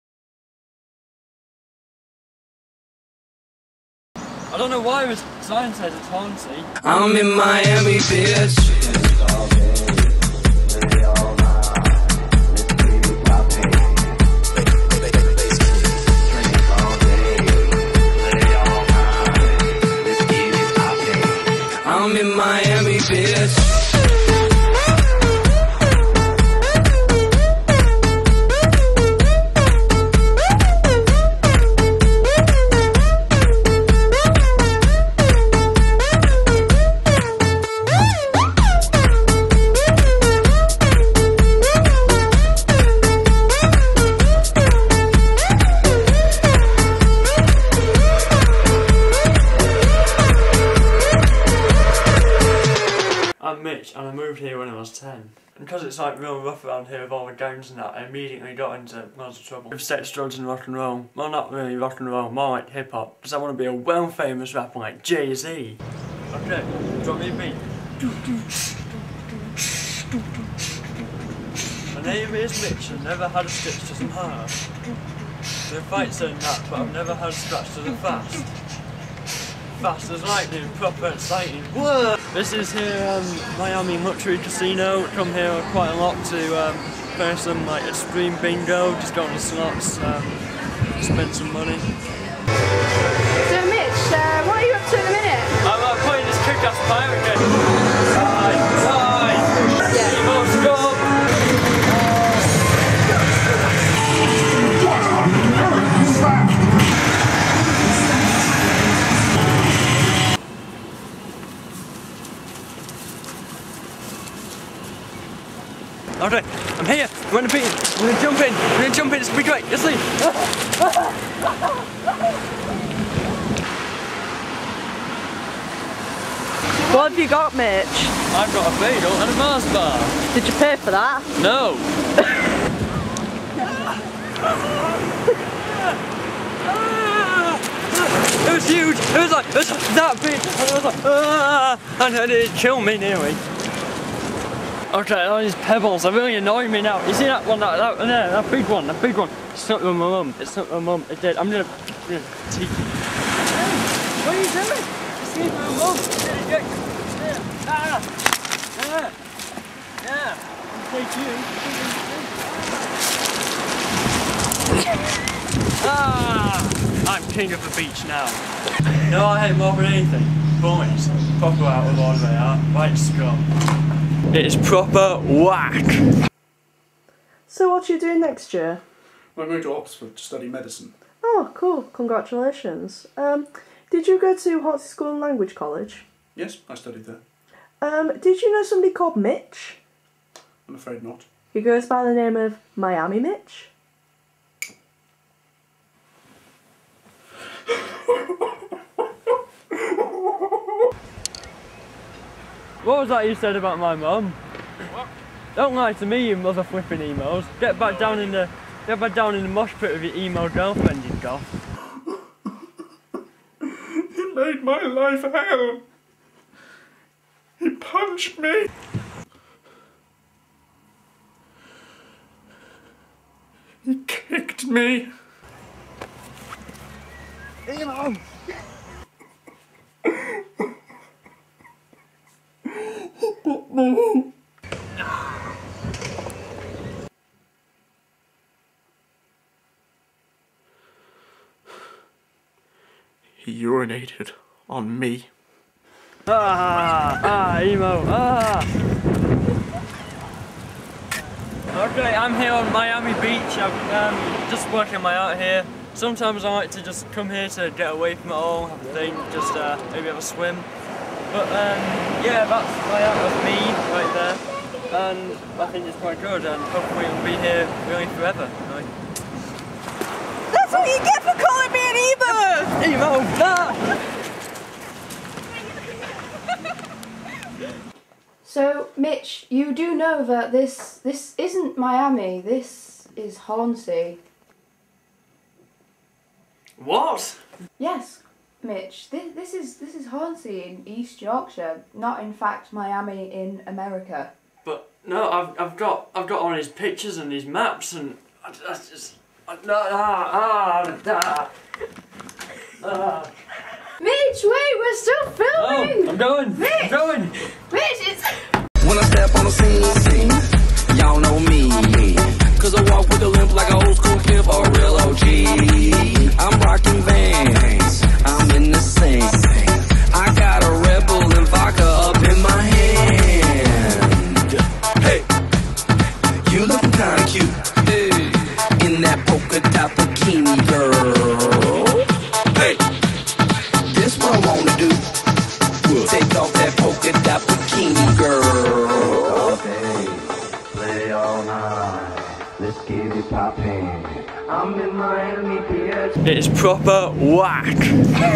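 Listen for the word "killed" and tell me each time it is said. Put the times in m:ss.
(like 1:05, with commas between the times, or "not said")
2:22.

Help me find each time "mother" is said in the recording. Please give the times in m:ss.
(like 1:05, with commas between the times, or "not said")
3:26.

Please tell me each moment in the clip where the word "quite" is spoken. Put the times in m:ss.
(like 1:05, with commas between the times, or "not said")
1:25, 4:25.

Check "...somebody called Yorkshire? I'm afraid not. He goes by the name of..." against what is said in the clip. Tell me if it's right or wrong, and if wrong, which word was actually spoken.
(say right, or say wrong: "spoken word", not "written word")
wrong: "Mitch", not "Yorkshire".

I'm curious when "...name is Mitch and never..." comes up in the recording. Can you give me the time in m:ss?
1:12.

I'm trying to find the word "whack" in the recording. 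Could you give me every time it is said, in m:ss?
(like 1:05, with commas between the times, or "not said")
2:55, 5:47.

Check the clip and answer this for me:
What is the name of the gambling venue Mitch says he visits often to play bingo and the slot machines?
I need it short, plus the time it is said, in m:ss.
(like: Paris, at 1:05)
Miami Luxury Casino, at 1:23.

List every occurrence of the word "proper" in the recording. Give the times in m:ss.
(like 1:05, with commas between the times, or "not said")
1:20, 2:54, 5:46.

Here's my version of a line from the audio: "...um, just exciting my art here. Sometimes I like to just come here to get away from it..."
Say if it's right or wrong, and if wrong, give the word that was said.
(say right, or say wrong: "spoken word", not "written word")
wrong: "working", not "exciting".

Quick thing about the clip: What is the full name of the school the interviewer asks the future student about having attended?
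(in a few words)
Hornsea School and Language College.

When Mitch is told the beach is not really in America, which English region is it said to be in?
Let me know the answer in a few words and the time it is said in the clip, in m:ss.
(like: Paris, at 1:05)
East Yorkshire, at 4:50.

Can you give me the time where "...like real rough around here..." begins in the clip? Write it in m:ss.
0:55.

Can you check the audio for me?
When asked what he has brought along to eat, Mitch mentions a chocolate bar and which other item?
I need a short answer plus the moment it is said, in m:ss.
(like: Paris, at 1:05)
A bagel, at 2:08.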